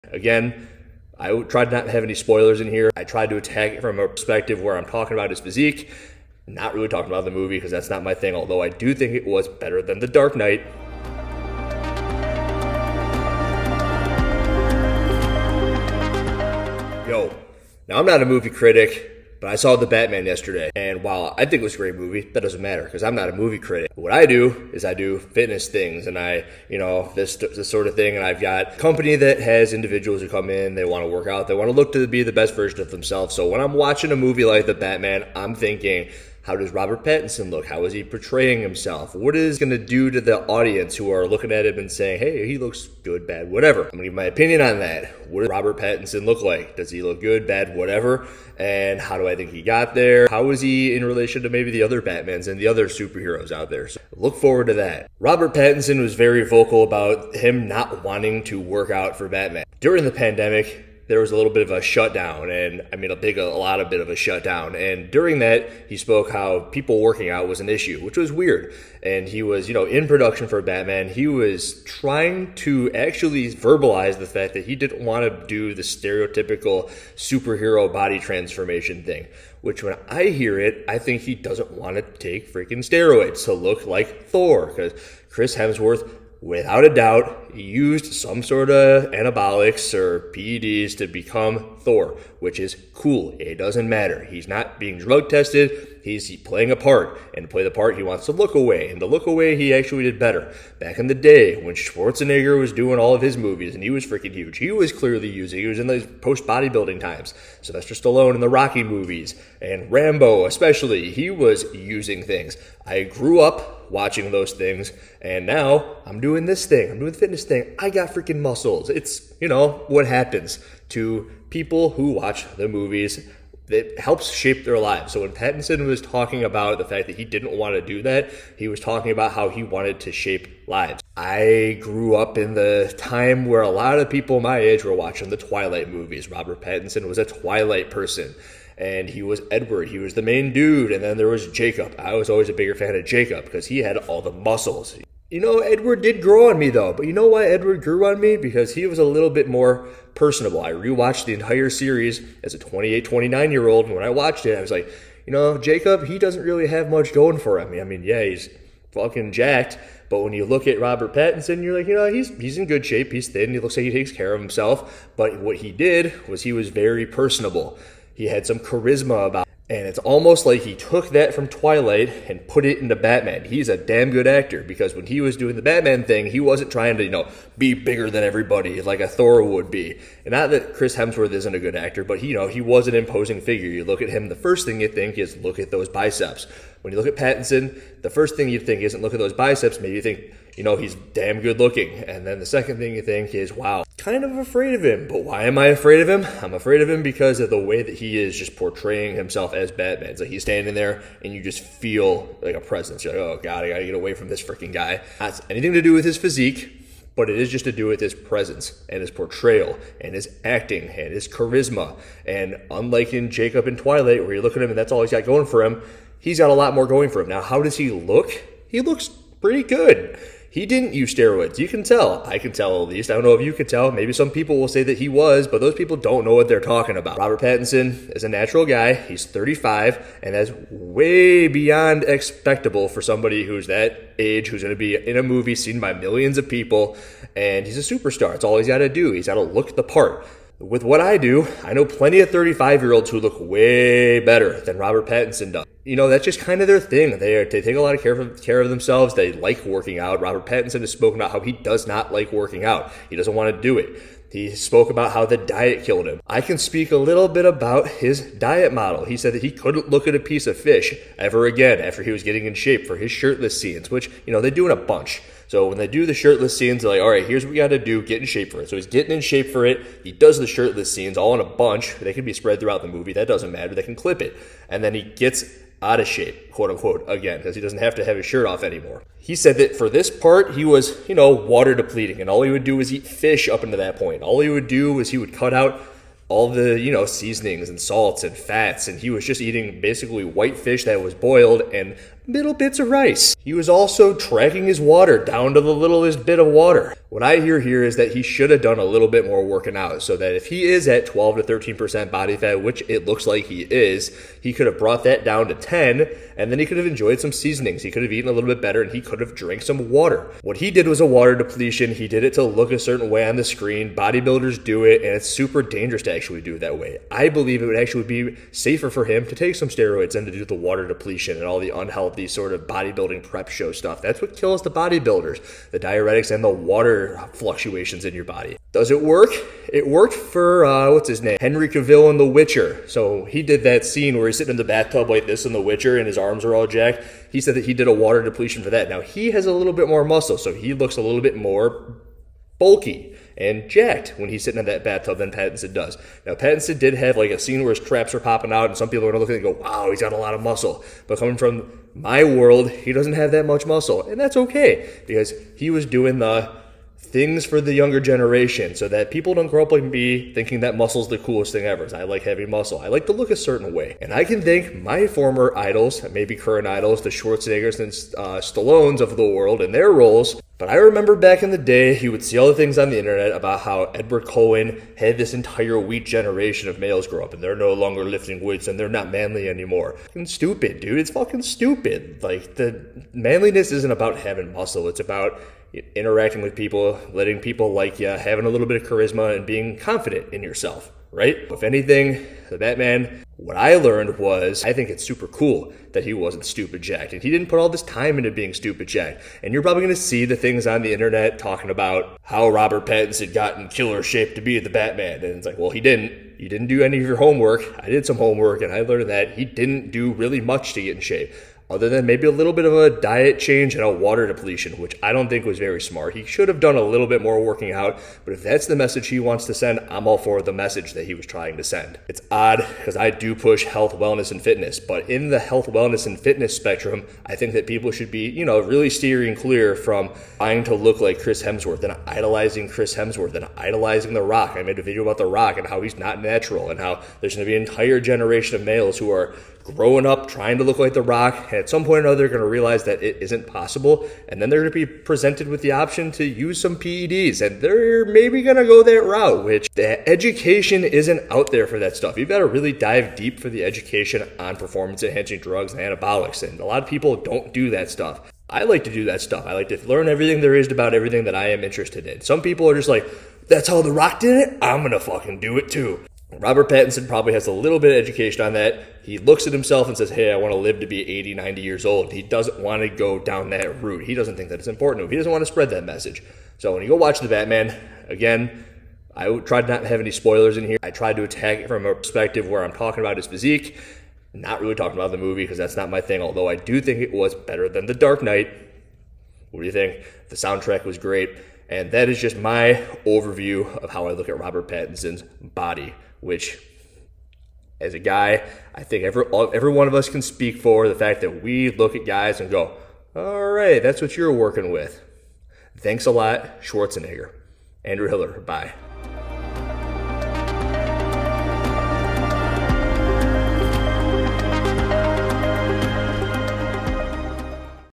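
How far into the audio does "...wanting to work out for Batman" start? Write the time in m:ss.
0:58.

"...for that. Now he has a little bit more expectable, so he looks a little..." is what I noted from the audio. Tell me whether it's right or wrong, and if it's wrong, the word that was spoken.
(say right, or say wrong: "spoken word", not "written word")
wrong: "muscle", not "expectable".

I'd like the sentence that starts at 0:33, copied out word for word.
So when I'm watching a movie like The Batman, I'm thinking how does Robert Pattinson look?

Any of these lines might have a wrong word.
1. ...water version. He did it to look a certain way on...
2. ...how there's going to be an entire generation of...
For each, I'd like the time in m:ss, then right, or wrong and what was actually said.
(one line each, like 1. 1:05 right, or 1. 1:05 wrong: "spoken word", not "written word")
1. 5:11 wrong: "depletion", not "version"
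2. 7:16 right.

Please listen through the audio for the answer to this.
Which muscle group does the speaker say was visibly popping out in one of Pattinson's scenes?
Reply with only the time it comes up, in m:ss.
5:47.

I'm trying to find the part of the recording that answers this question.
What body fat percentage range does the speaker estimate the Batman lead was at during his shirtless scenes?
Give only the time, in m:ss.
5:01.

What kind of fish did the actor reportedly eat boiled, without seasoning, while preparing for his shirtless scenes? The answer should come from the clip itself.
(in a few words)
white fish.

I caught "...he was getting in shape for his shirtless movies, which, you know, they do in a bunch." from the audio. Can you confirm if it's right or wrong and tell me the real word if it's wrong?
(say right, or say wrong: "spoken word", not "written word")
wrong: "scenes", not "movies".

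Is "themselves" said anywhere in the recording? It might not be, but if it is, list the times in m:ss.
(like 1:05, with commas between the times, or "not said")
0:32, 4:08.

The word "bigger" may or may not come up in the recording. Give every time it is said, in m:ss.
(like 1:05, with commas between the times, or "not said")
2:22, 2:57.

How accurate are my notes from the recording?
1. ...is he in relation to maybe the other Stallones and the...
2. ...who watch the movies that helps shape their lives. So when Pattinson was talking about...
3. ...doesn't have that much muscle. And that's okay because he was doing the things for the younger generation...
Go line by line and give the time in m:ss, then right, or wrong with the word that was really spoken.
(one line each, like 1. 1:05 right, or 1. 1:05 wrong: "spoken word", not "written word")
1. 0:50 wrong: "Batmans", not "Stallones"
2. 2:01 right
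3. 5:52 right.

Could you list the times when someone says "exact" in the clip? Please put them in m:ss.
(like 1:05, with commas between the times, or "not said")
not said.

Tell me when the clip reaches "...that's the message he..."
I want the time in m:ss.
6:58.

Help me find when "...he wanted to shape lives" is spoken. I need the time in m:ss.
2:09.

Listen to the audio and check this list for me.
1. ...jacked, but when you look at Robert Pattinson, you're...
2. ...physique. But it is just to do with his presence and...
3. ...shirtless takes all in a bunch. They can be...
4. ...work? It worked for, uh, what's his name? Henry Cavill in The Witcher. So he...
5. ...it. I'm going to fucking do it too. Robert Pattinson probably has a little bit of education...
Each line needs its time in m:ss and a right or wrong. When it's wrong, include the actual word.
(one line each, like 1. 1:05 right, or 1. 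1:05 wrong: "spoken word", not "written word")
1. 2:39 right
2. 3:26 right
3. 4:30 wrong: "scenes", not "takes"
4. 5:29 right
5. 7:44 right.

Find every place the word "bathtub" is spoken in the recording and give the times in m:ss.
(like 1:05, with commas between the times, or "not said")
5:34, 5:44.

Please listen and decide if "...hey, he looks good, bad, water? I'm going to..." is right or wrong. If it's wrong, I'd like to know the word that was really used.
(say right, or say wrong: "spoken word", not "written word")
wrong: "whatever", not "water".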